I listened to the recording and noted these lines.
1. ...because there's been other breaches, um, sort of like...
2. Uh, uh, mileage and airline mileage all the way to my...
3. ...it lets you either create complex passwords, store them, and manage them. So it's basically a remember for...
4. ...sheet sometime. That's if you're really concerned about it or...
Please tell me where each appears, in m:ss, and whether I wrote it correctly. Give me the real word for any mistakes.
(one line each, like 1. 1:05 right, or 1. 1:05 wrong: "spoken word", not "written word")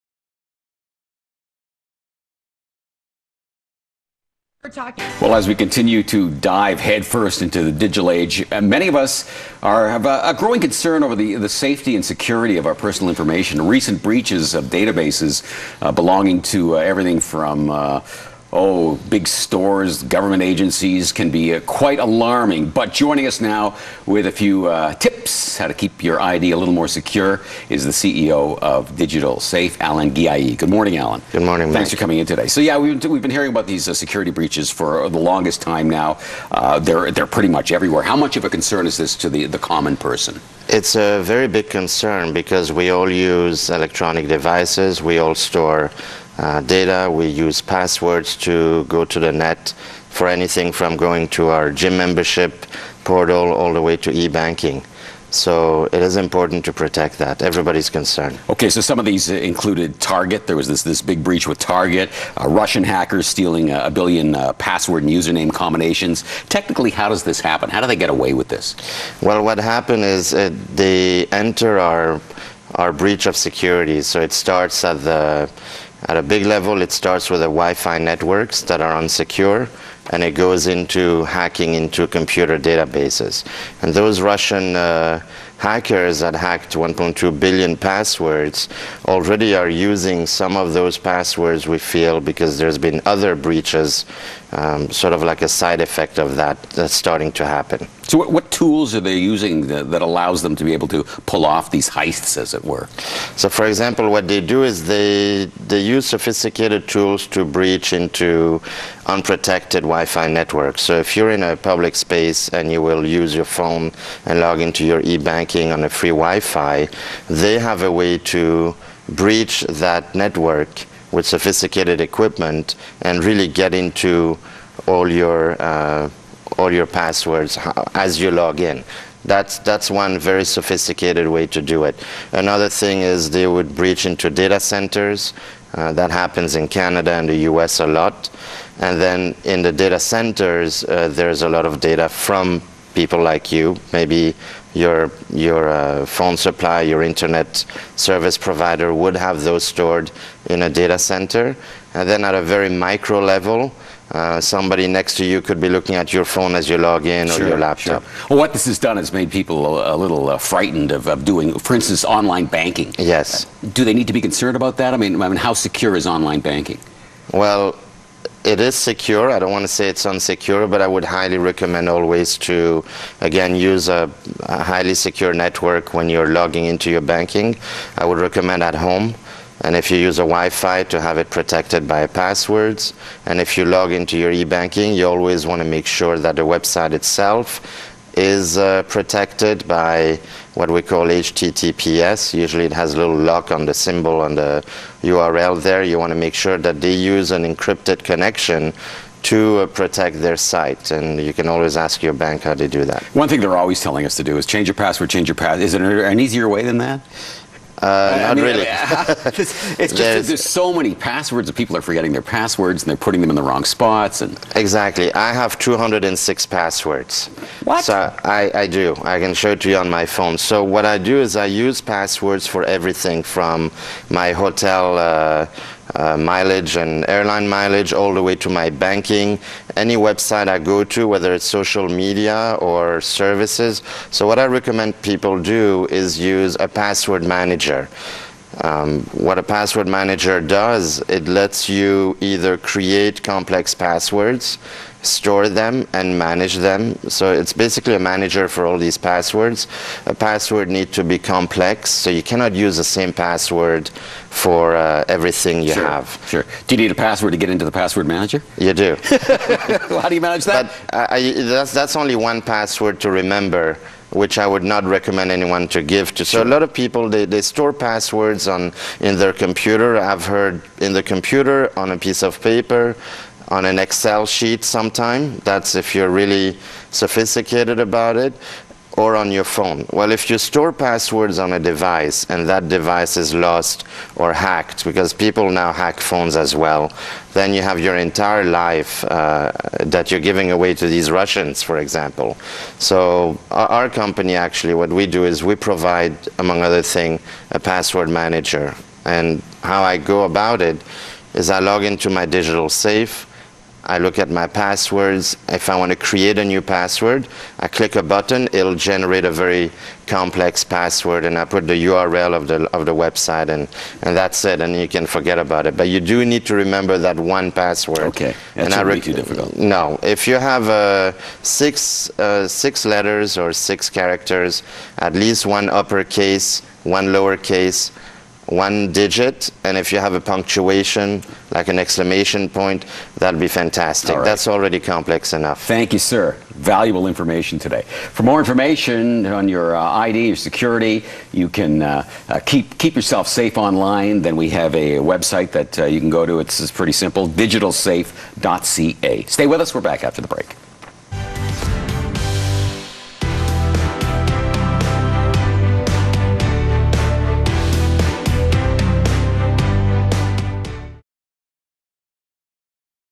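1. 1:32 right
2. 3:44 right
3. 4:01 wrong: "manager", not "remember"
4. 4:34 wrong: "sophisticated", not "concerned".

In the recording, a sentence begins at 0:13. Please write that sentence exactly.
Recent breaches of databases uh, belonging to uh, everything from uh, oh, big stores, government agencies can be uh, quite alarming.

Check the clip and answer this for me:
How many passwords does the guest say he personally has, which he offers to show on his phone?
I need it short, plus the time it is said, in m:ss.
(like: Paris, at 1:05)
206, at 3:35.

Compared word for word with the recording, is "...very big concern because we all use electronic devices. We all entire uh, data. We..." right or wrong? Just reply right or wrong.
wrong.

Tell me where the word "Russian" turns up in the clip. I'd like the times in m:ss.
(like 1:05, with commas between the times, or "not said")
1:02, 1:24, 4:51.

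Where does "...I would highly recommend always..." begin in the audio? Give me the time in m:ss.
2:50.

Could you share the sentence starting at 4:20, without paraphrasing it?
But, uh, I, that's, that's only one password to remember which I would not recommend anyone to give to.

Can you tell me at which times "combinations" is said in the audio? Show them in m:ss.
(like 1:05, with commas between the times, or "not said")
1:05.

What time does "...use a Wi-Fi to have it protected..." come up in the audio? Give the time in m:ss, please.
2:59.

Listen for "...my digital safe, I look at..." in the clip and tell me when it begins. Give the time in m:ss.
5:02.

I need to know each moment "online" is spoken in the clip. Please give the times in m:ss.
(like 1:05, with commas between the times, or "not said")
2:42, 2:46, 5:43.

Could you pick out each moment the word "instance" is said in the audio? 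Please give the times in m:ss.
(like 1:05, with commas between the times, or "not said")
2:41.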